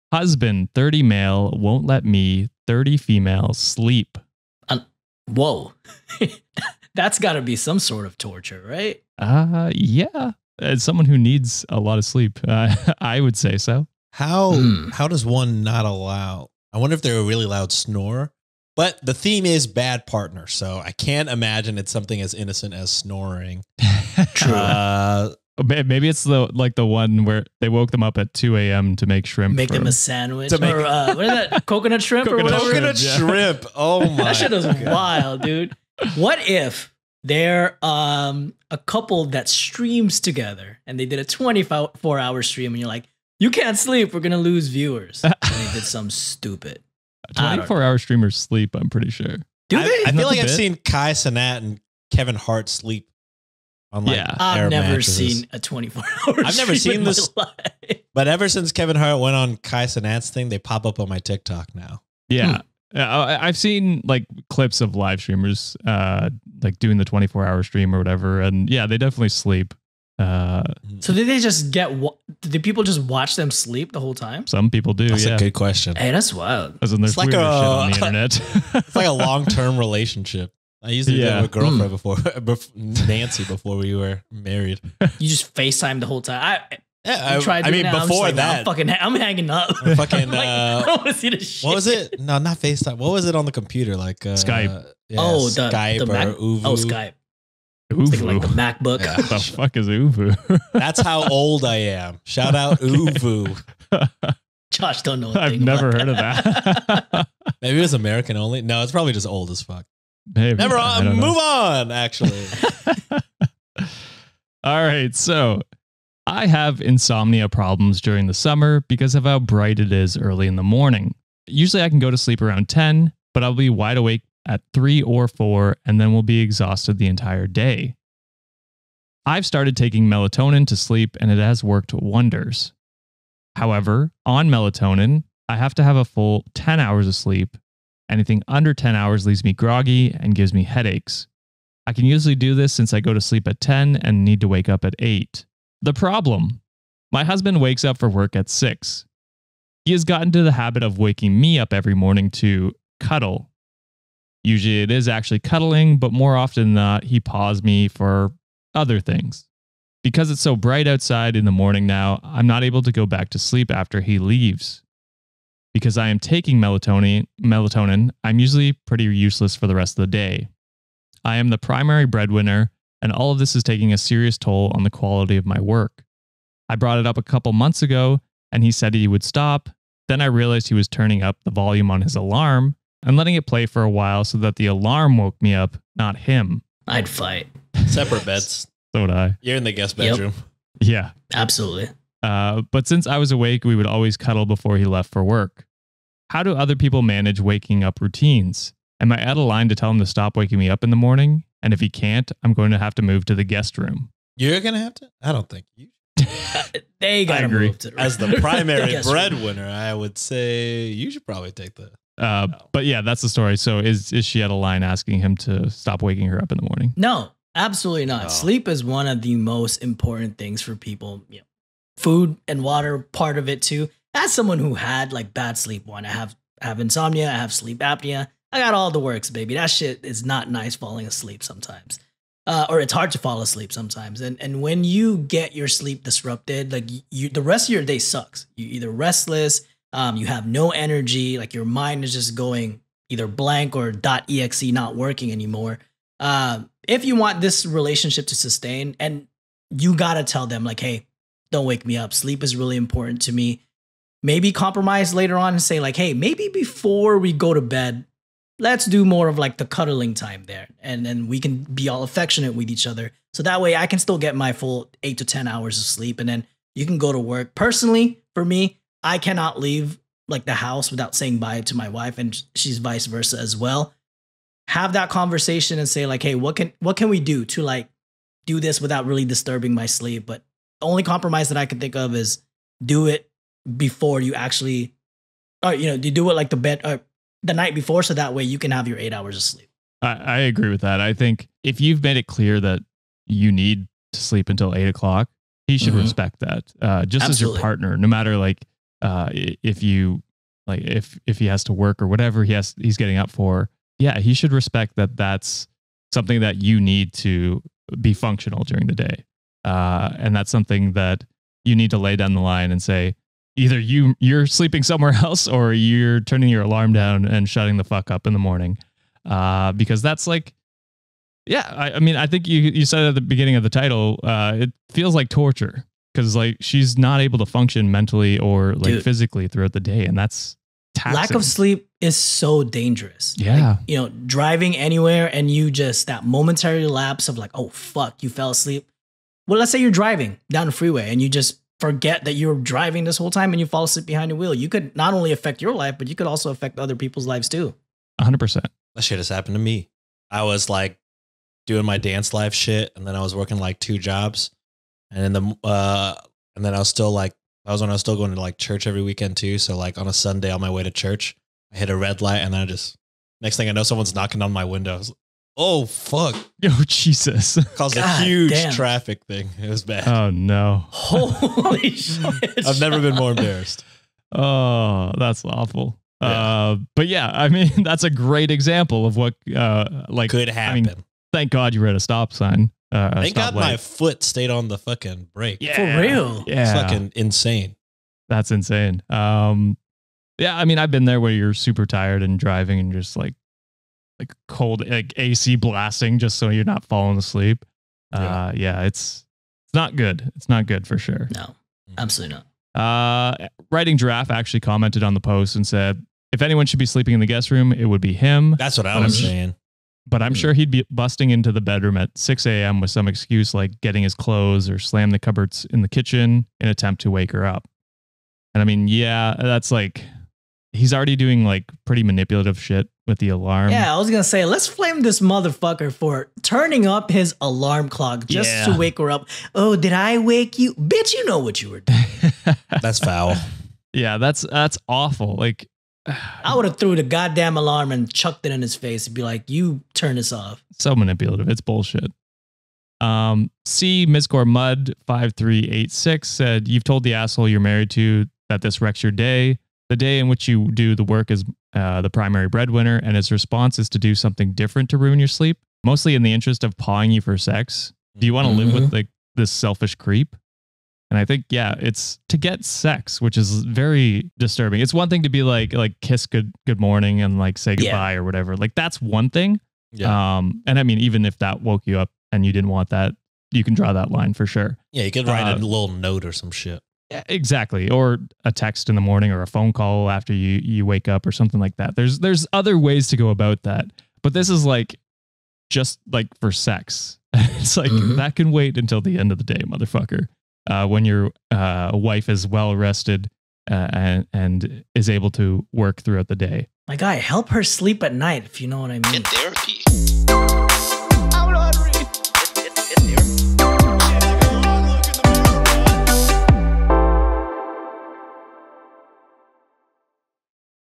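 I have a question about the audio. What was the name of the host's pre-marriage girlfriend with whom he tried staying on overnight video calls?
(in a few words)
Nancy.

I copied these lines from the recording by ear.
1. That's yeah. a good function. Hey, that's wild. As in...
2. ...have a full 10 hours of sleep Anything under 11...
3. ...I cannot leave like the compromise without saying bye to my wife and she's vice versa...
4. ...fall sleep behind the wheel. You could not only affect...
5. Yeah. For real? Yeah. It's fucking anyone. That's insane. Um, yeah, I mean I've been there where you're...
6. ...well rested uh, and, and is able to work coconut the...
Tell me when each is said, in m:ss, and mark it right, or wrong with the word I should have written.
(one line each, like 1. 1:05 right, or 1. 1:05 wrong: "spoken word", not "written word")
1. 1:15 wrong: "question", not "function"
2. 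2:15 wrong: "10", not "11"
3. 4:29 wrong: "house", not "compromise"
4. 5:43 wrong: "asleep", not "sleep"
5. 6:25 wrong: "insane", not "anyone"
6. 8:12 wrong: "throughout", not "coconut".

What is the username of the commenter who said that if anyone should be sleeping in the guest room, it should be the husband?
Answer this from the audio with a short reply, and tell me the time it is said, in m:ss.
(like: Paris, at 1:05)
writing giraffe, at 6:43.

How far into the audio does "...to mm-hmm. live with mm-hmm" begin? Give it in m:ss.
7:38.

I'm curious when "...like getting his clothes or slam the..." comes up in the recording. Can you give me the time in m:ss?
6:53.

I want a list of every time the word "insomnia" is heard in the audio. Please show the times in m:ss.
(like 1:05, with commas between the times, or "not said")
1:56, 3:46.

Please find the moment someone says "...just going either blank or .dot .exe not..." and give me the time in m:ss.
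4:02.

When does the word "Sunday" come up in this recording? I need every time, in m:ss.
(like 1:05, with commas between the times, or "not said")
6:00.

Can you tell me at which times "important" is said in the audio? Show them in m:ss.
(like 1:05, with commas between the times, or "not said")
3:39, 4:12.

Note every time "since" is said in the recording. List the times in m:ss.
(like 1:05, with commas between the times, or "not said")
0:58, 2:22, 3:12.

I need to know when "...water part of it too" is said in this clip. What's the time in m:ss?
3:42.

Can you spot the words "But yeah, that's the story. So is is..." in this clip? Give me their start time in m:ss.
3:32.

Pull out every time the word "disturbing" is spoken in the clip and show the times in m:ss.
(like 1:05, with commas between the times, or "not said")
4:39, 7:44.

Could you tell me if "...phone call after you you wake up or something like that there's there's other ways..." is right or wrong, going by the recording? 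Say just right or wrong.
right.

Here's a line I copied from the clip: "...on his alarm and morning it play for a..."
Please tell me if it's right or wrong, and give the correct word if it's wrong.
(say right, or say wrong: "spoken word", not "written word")
wrong: "letting", not "morning".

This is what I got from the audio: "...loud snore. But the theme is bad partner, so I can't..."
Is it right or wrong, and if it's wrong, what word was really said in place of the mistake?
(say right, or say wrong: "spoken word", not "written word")
right.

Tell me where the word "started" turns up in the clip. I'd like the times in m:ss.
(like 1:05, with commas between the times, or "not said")
2:09.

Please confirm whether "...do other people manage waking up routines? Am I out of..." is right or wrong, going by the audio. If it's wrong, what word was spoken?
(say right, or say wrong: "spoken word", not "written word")
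right.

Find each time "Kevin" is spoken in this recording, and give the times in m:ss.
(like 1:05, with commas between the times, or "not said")
0:52, 0:58.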